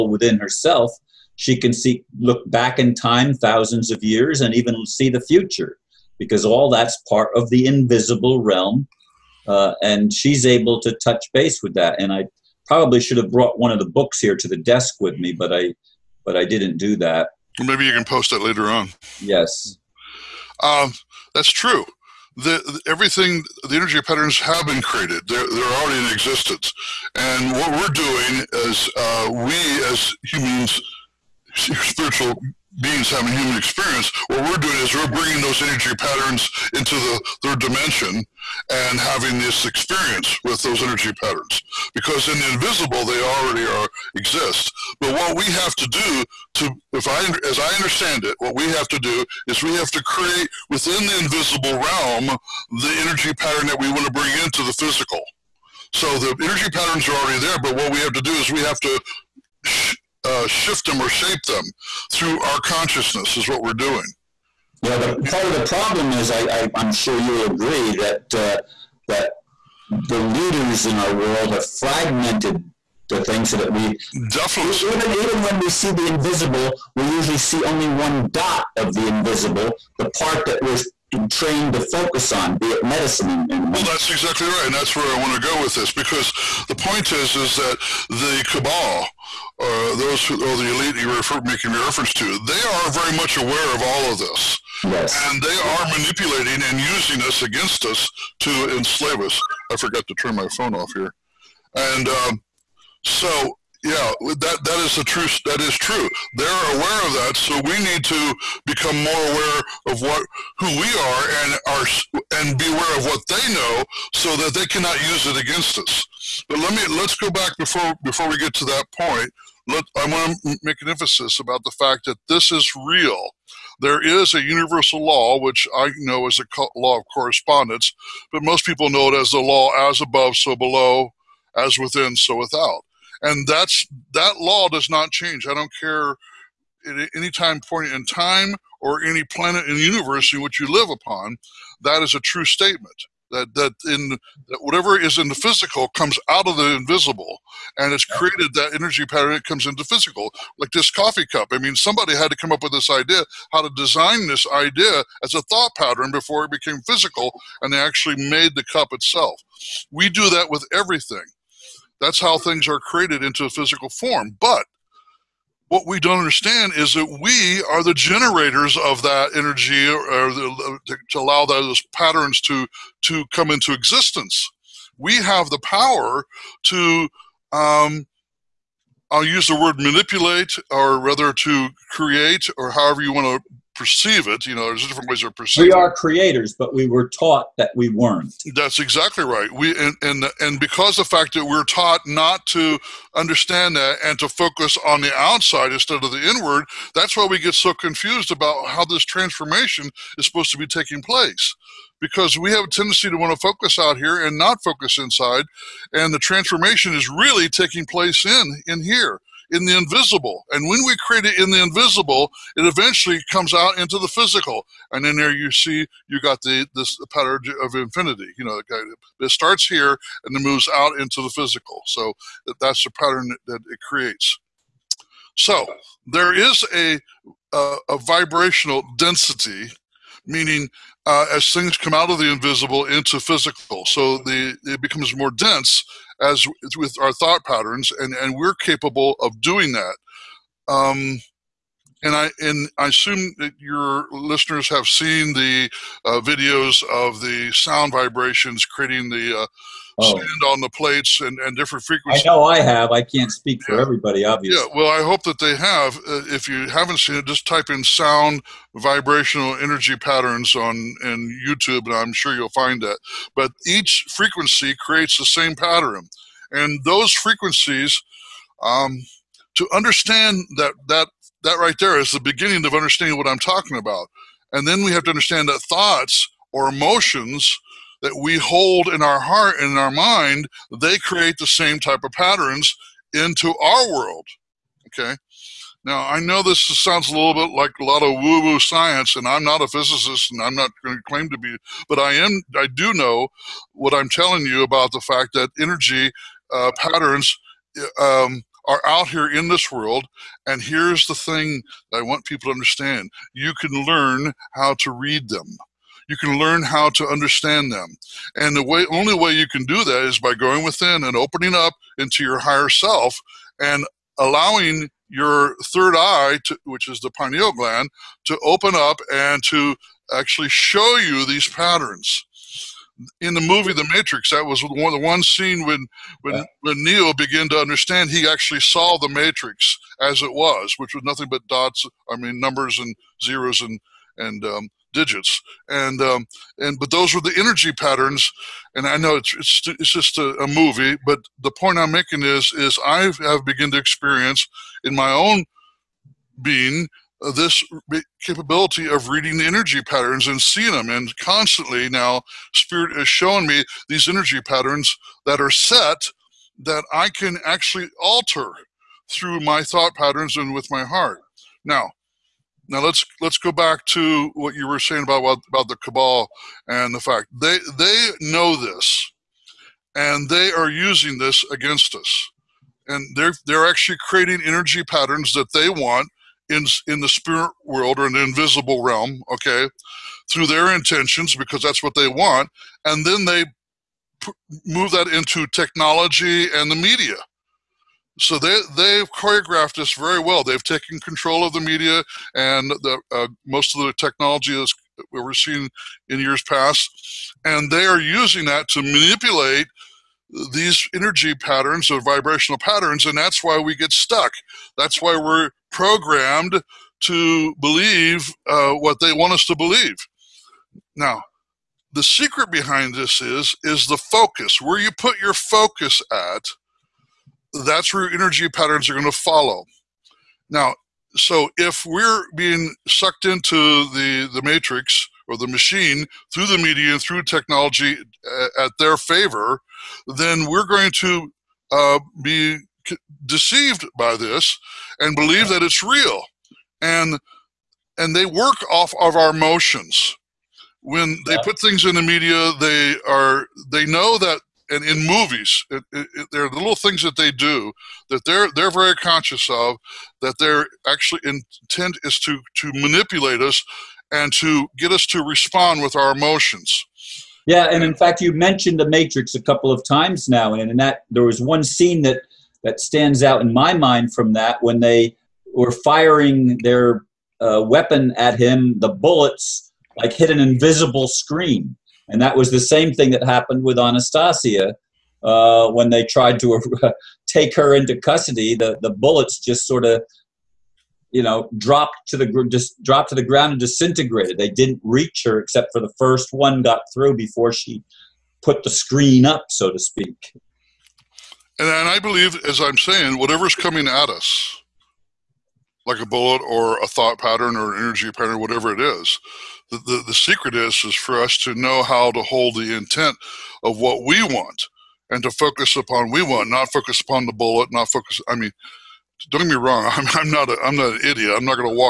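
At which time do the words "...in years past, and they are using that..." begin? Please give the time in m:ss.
6:36.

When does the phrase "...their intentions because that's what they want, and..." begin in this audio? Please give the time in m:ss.
6:20.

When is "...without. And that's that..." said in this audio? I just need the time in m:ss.
2:12.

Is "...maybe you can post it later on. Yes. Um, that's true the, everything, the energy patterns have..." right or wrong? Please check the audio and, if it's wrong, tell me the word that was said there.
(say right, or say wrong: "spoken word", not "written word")
right.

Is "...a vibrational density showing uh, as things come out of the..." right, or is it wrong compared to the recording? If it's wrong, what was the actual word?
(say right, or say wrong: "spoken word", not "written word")
wrong: "meaning", not "showing".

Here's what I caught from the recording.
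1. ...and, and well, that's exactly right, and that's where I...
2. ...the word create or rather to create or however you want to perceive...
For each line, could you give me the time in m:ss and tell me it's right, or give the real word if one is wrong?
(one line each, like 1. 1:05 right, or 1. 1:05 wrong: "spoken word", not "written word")
1. 1:23 right
2. 2:59 wrong: "manipulate", not "create".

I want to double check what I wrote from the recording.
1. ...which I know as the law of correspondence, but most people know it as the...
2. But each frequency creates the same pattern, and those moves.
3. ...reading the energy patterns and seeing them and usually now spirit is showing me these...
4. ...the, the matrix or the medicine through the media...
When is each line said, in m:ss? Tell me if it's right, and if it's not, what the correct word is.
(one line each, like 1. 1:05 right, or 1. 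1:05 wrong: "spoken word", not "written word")
1. 2:05 right
2. 4:23 wrong: "frequencies", not "moves"
3. 5:49 wrong: "constantly", not "usually"
4. 7:03 wrong: "machine", not "medicine".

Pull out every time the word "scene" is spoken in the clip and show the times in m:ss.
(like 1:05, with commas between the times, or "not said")
5:25, 7:41.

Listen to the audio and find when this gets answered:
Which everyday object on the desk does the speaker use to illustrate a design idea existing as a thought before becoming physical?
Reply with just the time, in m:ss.
2:30.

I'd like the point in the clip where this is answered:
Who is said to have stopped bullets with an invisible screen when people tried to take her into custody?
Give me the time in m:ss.
7:53.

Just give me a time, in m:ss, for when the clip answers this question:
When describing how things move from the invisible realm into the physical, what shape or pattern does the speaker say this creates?
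3:37.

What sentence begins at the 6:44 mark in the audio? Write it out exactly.
That's why we're programmed to believe uh, what they want us to believe.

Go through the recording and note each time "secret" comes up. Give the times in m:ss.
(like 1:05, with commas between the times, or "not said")
6:52, 8:20.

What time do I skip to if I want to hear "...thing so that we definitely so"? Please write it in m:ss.
1:13.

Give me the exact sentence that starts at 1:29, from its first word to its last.
Uh, those who, or the elite you refer making reference to, they are very much aware of all of this.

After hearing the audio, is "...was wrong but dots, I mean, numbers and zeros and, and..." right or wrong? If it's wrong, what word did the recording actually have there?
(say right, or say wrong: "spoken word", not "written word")
wrong: "nothing", not "wrong".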